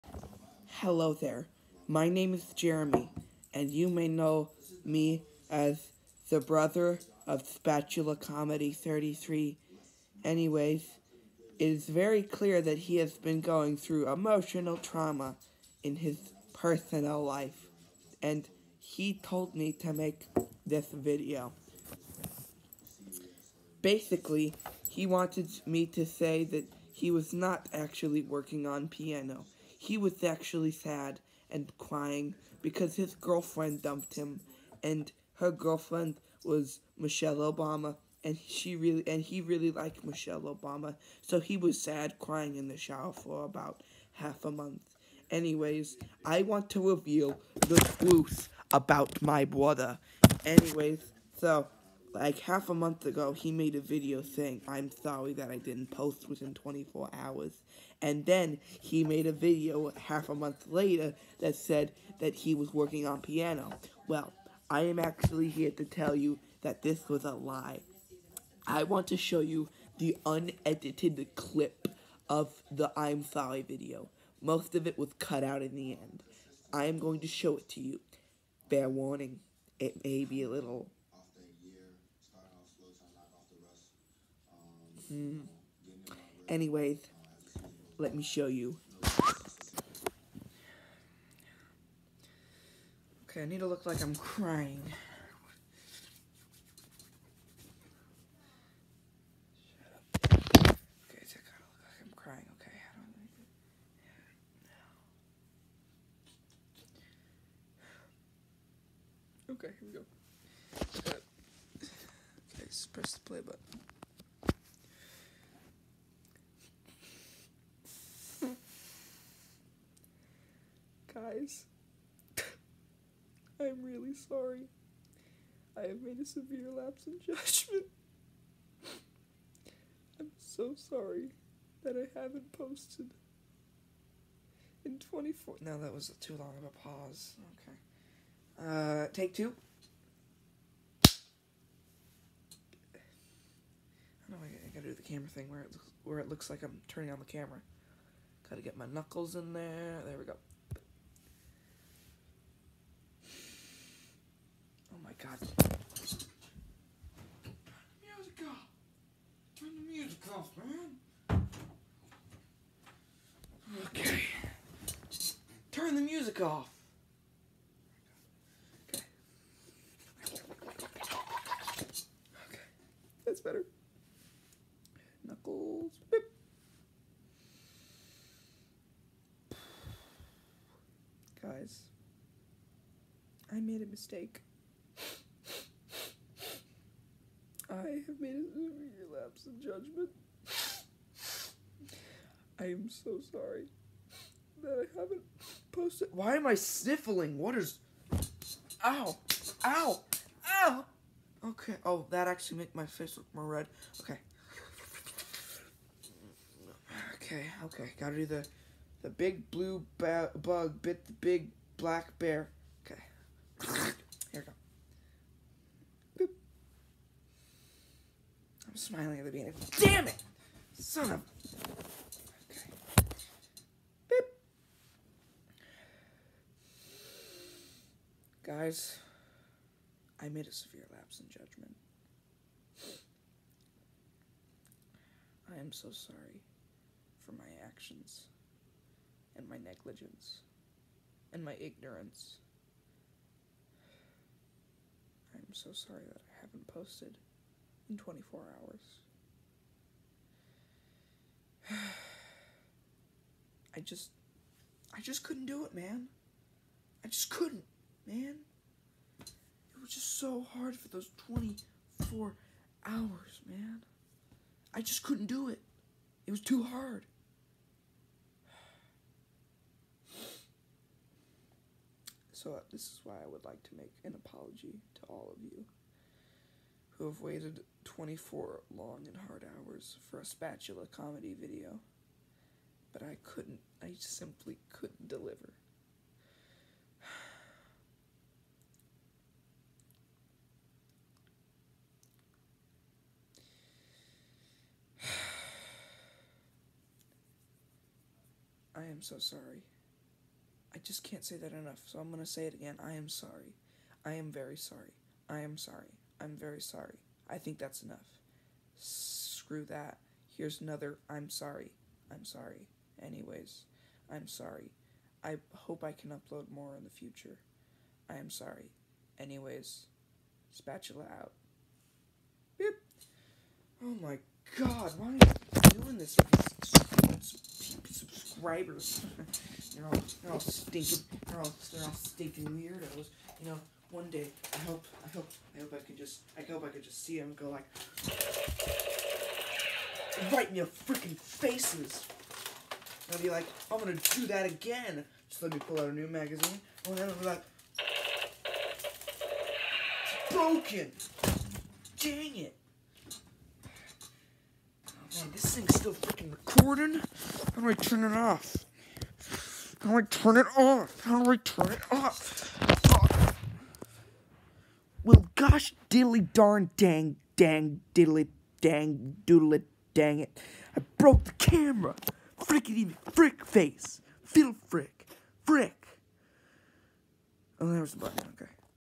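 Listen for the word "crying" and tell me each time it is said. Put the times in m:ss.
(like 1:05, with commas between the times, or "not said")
0:31, 0:42.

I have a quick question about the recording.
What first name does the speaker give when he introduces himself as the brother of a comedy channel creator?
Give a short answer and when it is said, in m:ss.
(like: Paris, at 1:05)
Jeremy, at 0:02.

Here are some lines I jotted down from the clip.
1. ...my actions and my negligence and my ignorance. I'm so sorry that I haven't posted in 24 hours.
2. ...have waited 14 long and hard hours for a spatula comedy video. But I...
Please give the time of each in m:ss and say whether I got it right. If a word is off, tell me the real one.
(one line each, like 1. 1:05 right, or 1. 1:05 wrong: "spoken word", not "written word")
1. 3:57 right
2. 4:37 wrong: "24", not "14".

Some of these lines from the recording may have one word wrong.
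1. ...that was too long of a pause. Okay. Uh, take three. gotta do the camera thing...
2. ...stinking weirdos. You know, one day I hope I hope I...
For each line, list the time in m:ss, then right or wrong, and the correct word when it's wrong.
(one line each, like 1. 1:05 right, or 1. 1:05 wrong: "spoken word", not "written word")
1. 2:15 wrong: "two", not "three"
2. 5:31 right.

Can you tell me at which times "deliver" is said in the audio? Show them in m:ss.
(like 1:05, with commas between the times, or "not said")
4:45.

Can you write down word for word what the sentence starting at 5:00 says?
I just can't say that enough, so I'm going to say it again.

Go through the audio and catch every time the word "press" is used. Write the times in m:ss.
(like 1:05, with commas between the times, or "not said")
1:52.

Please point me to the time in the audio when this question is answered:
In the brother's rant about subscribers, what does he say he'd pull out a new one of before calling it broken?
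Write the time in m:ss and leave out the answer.
5:46.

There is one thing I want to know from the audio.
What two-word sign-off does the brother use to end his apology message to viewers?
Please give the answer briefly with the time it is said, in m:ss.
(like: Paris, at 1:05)
Spatula out, at 5:20.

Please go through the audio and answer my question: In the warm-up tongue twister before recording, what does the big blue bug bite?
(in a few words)
Big black bear.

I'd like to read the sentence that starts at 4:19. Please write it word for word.
It was just so hard for those 24 hours, man.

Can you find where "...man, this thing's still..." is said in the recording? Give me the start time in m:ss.
5:55.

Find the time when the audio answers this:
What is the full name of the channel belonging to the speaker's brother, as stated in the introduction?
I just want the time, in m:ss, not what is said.
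0:07.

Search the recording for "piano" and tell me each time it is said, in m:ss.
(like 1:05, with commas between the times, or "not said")
0:28, 1:03.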